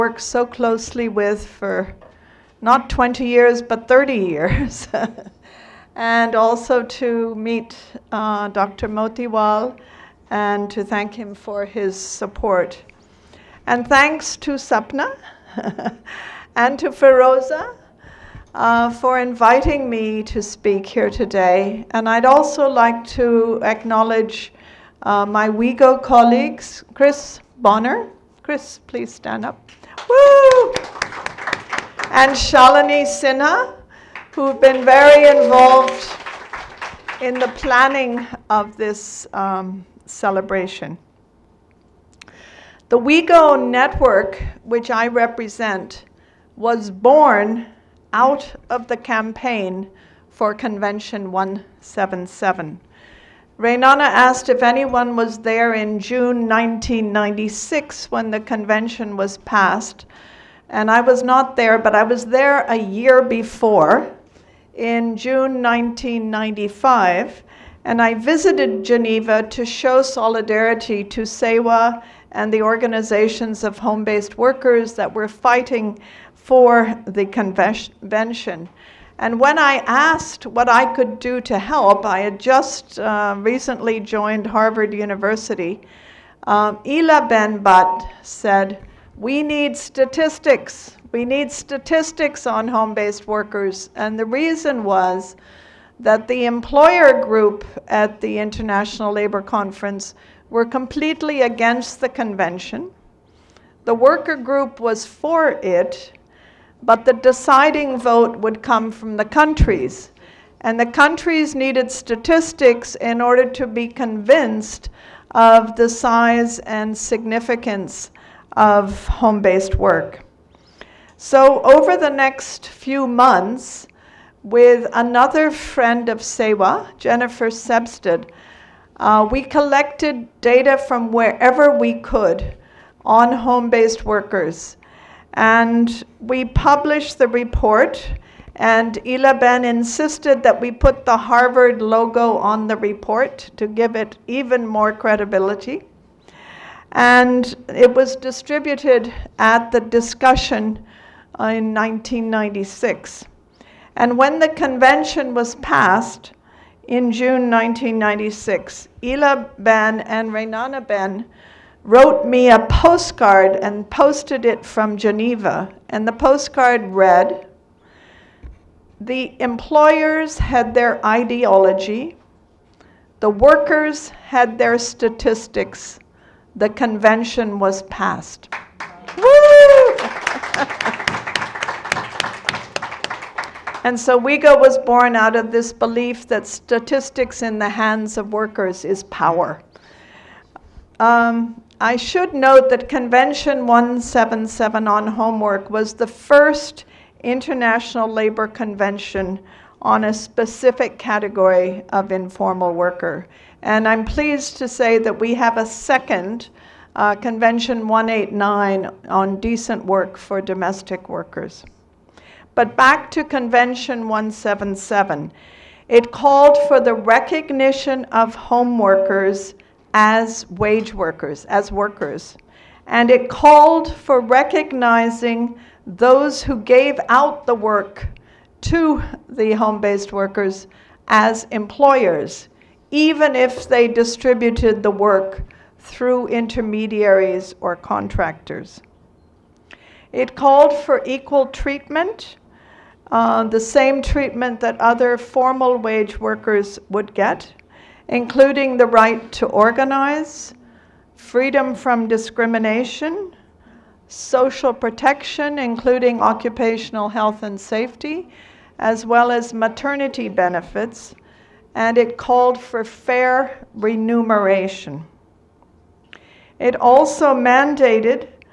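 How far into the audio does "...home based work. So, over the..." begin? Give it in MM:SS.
01:59.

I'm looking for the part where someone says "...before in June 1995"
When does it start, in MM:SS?
01:03.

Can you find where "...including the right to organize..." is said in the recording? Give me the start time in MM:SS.
04:08.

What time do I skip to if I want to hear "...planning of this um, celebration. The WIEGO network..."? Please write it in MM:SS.
00:37.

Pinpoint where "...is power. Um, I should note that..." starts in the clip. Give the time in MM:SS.
03:08.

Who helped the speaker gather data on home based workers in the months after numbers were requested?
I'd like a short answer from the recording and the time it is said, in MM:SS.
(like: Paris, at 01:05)
Jennifer Sebstad, at 02:06.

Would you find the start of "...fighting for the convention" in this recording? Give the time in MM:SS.
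01:15.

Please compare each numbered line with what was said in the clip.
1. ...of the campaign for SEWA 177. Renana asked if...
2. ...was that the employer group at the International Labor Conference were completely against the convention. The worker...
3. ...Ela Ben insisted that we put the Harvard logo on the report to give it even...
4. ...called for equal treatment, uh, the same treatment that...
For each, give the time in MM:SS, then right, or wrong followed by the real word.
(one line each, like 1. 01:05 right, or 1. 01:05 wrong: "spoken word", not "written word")
1. 00:48 wrong: "Convention", not "SEWA"
2. 01:34 right
3. 02:19 right
4. 04:00 right.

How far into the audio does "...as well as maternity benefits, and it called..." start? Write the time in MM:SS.
04:18.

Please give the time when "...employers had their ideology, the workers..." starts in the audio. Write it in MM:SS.
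02:49.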